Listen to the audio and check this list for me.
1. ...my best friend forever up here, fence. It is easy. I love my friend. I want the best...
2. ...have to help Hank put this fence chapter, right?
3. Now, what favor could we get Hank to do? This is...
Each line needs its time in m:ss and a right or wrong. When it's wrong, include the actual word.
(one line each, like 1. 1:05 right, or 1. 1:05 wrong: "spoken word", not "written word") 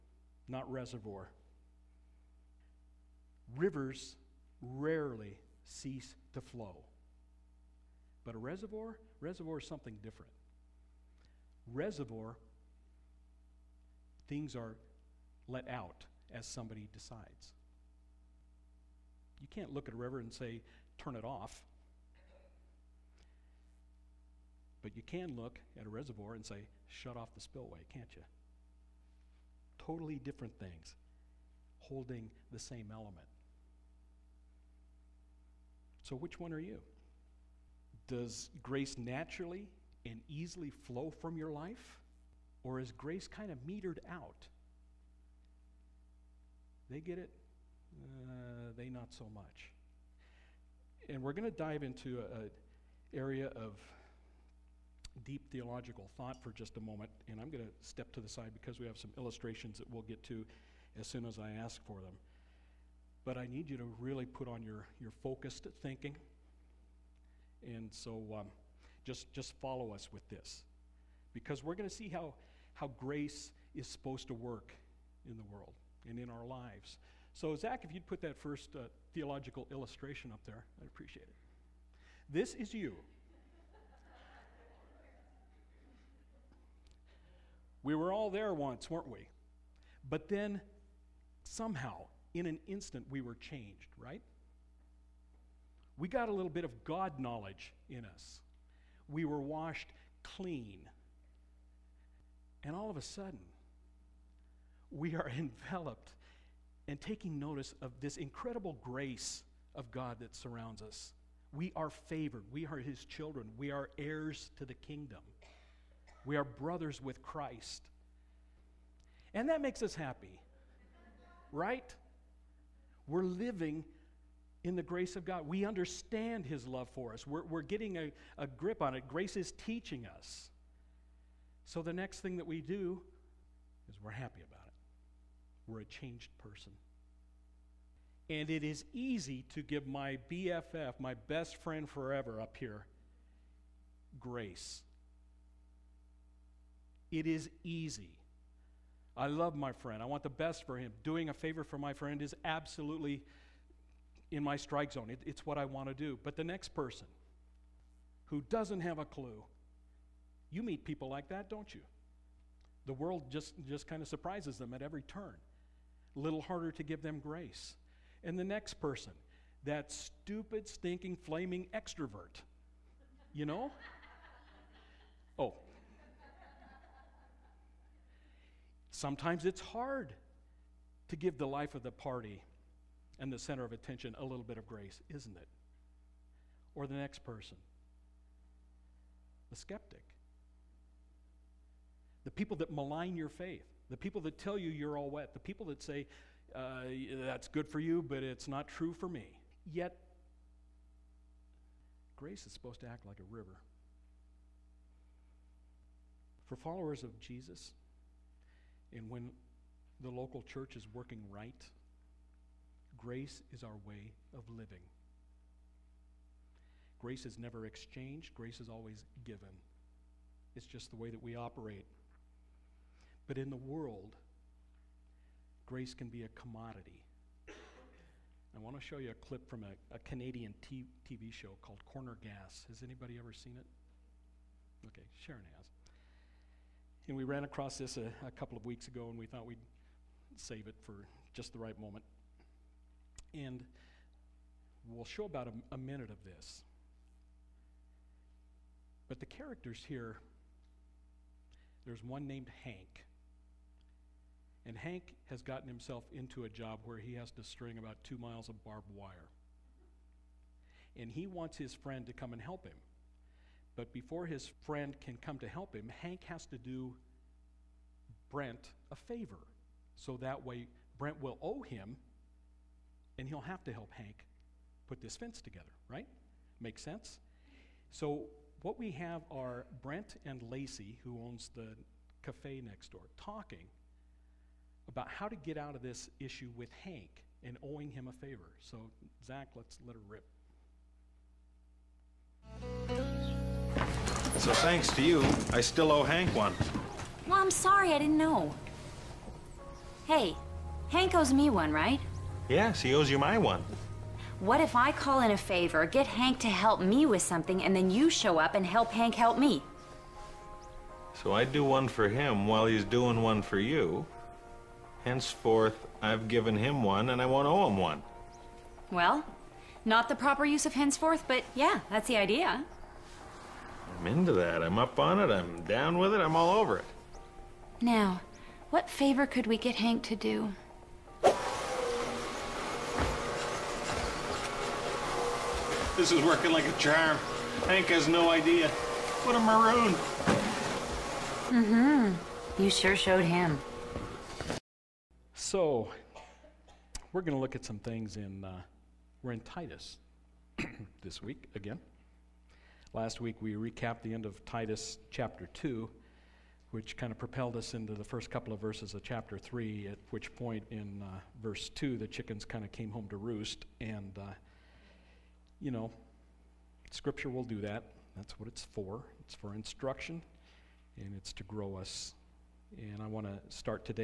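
1. 2:20 wrong: "grace", not "fence"
2. 4:33 wrong: "together", not "chapter"
3. 5:27 right.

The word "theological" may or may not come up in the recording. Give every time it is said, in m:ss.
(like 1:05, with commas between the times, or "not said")
0:55, 1:19.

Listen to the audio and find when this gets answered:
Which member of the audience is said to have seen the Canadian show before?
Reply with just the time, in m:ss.
3:55.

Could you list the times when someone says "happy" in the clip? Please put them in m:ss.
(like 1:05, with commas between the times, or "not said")
1:59, 2:14.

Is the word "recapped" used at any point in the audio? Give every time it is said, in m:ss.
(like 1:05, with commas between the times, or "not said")
5:53.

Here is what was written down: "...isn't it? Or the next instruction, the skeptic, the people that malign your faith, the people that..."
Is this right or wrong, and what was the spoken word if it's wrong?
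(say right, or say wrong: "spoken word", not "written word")
wrong: "person", not "instruction".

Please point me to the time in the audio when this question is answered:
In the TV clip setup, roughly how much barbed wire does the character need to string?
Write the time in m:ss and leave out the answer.
4:18.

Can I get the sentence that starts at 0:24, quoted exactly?
But you can look at a reservoir and say, shut off the spillway, can't you?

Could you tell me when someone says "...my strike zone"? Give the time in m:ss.
2:34.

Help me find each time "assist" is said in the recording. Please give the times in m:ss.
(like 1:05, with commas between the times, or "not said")
not said.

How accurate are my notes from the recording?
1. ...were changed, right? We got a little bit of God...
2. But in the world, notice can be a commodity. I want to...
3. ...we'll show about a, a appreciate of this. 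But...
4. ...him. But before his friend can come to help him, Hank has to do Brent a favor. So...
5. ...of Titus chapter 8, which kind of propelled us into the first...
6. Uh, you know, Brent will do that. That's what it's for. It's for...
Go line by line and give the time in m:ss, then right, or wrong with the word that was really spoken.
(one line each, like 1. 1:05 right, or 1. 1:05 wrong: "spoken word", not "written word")
1. 1:33 right
2. 3:43 wrong: "grace", not "notice"
3. 4:04 wrong: "minute", not "appreciate"
4. 4:22 right
5. 5:54 wrong: "2", not "8"
6. 6:04 wrong: "Scripture", not "Brent".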